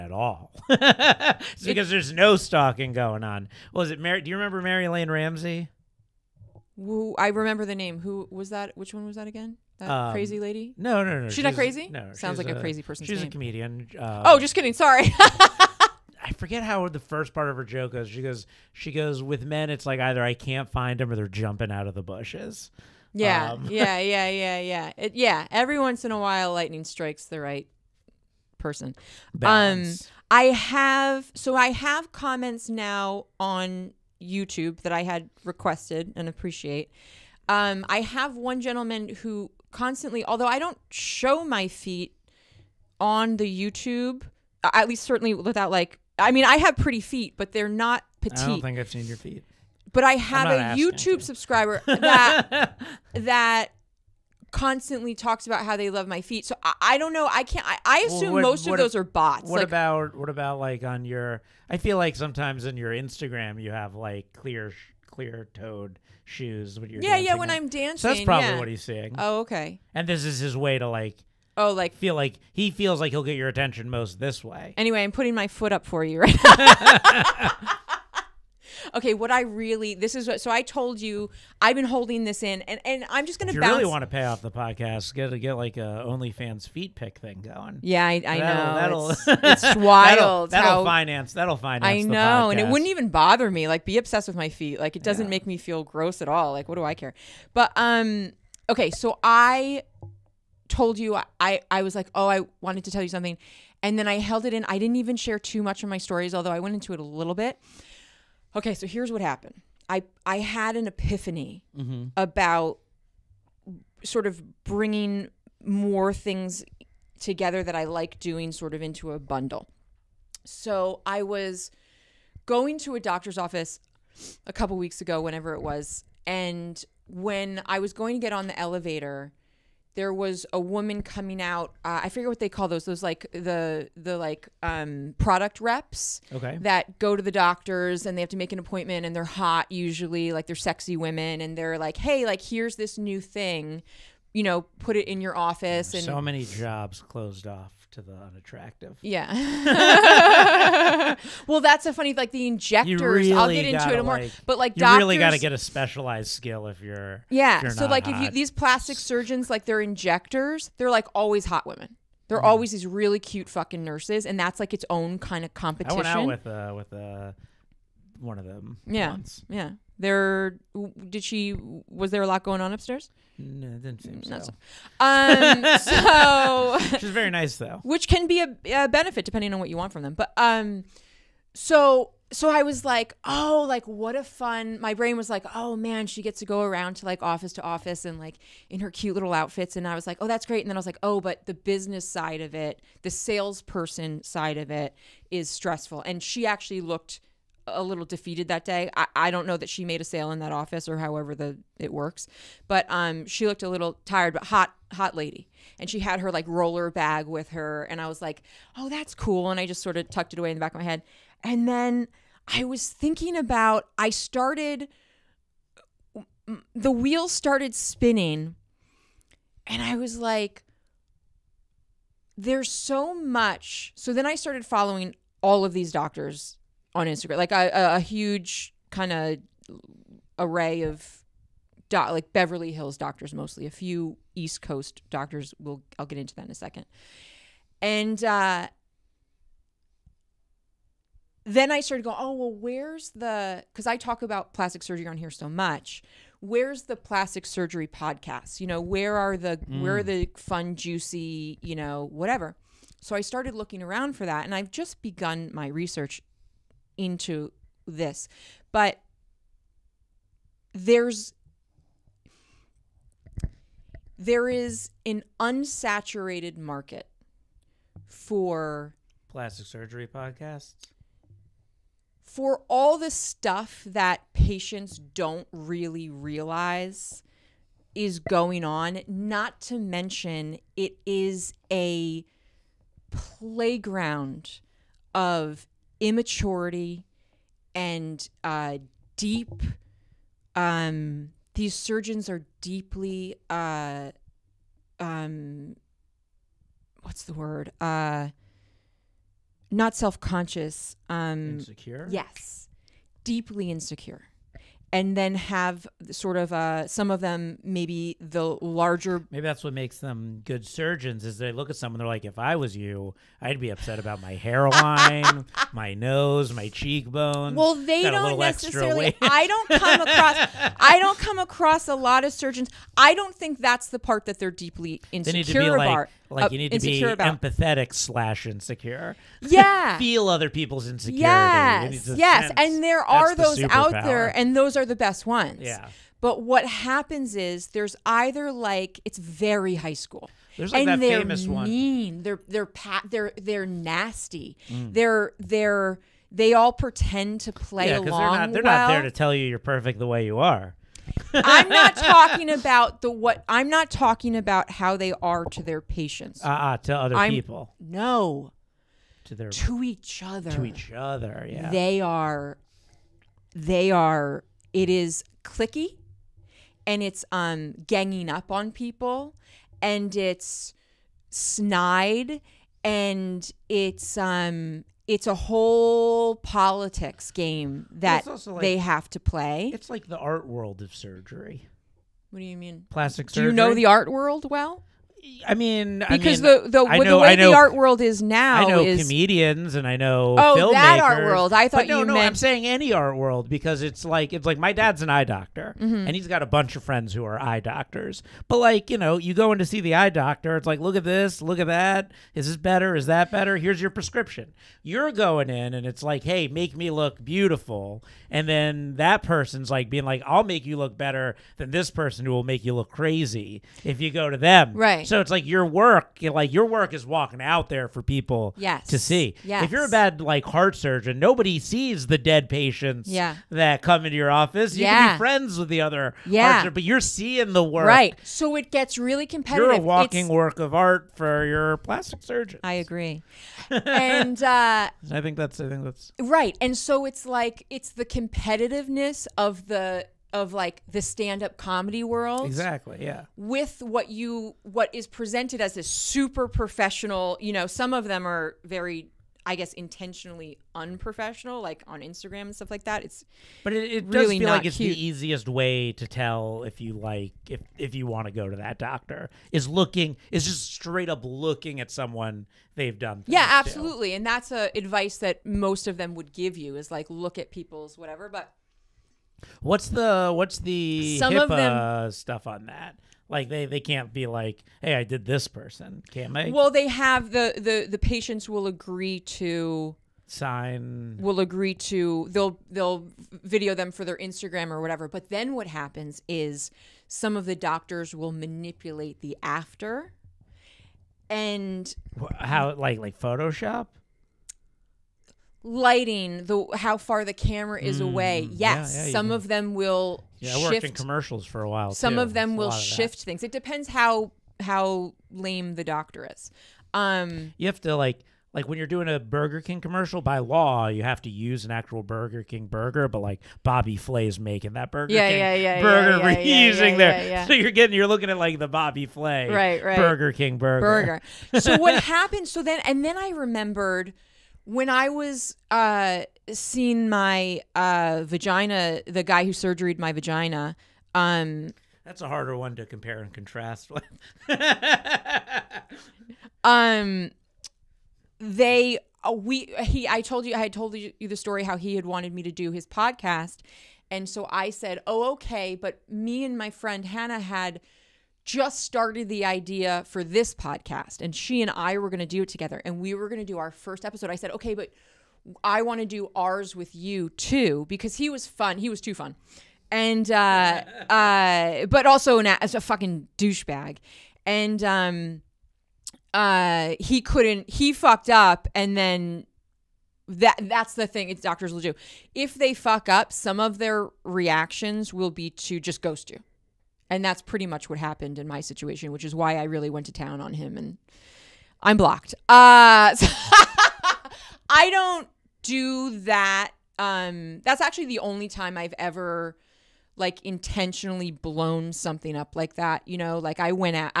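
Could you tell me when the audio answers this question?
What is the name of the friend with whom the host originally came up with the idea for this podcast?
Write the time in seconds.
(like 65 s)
547 s.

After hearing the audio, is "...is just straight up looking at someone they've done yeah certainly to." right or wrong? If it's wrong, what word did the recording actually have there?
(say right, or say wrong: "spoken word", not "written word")
wrong: "absolutely", not "certainly".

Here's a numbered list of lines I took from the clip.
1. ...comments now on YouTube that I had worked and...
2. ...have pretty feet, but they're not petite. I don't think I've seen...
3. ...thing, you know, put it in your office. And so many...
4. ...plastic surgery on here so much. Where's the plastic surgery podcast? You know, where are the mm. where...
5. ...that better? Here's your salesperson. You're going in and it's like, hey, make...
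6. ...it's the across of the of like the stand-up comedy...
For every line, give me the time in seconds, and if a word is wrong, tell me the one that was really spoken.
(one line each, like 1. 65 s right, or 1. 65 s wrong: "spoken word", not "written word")
1. 32 s wrong: "requested", not "worked"
2. 46 s right
3. 143 s right
4. 244 s right
5. 403 s wrong: "prescription", not "salesperson"
6. 437 s wrong: "competitiveness", not "across".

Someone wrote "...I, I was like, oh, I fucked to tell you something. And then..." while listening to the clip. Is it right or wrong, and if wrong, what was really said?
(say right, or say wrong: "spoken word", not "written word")
wrong: "wanted", not "fucked".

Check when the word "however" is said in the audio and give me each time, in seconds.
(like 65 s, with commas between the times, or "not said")
200 s.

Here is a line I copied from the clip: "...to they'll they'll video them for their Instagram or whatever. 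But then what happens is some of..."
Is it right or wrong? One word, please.
right.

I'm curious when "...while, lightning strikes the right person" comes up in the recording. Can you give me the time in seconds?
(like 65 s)
26 s.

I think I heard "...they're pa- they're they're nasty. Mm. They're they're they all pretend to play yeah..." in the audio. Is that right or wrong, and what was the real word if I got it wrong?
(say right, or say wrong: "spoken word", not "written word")
right.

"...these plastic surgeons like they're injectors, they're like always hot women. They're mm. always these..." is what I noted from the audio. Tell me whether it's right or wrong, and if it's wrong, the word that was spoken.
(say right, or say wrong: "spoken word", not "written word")
right.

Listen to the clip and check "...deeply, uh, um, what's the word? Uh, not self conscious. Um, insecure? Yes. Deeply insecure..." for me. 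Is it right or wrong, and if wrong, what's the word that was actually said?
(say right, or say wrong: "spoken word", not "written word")
right.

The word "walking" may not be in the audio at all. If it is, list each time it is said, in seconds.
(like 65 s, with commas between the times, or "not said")
417 s, 429 s.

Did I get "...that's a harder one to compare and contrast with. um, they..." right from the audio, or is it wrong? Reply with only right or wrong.
right.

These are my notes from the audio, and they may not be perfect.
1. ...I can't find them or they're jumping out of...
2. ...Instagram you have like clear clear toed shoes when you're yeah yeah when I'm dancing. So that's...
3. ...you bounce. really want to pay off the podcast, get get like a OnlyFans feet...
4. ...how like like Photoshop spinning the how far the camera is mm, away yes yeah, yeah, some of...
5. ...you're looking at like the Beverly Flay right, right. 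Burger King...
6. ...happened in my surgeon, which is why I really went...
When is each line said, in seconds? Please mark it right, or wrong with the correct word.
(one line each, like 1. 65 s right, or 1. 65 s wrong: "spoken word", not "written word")
1. 20 s right
2. 62 s right
3. 83 s right
4. 492 s wrong: "lighting", not "spinning"
5. 517 s wrong: "Bobby", not "Beverly"
6. 577 s wrong: "situation", not "surgeon".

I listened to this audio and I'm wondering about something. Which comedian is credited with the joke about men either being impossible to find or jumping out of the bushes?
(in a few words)
Mary Lane Ramsey.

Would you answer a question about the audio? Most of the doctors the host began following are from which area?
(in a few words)
Beverly Hills.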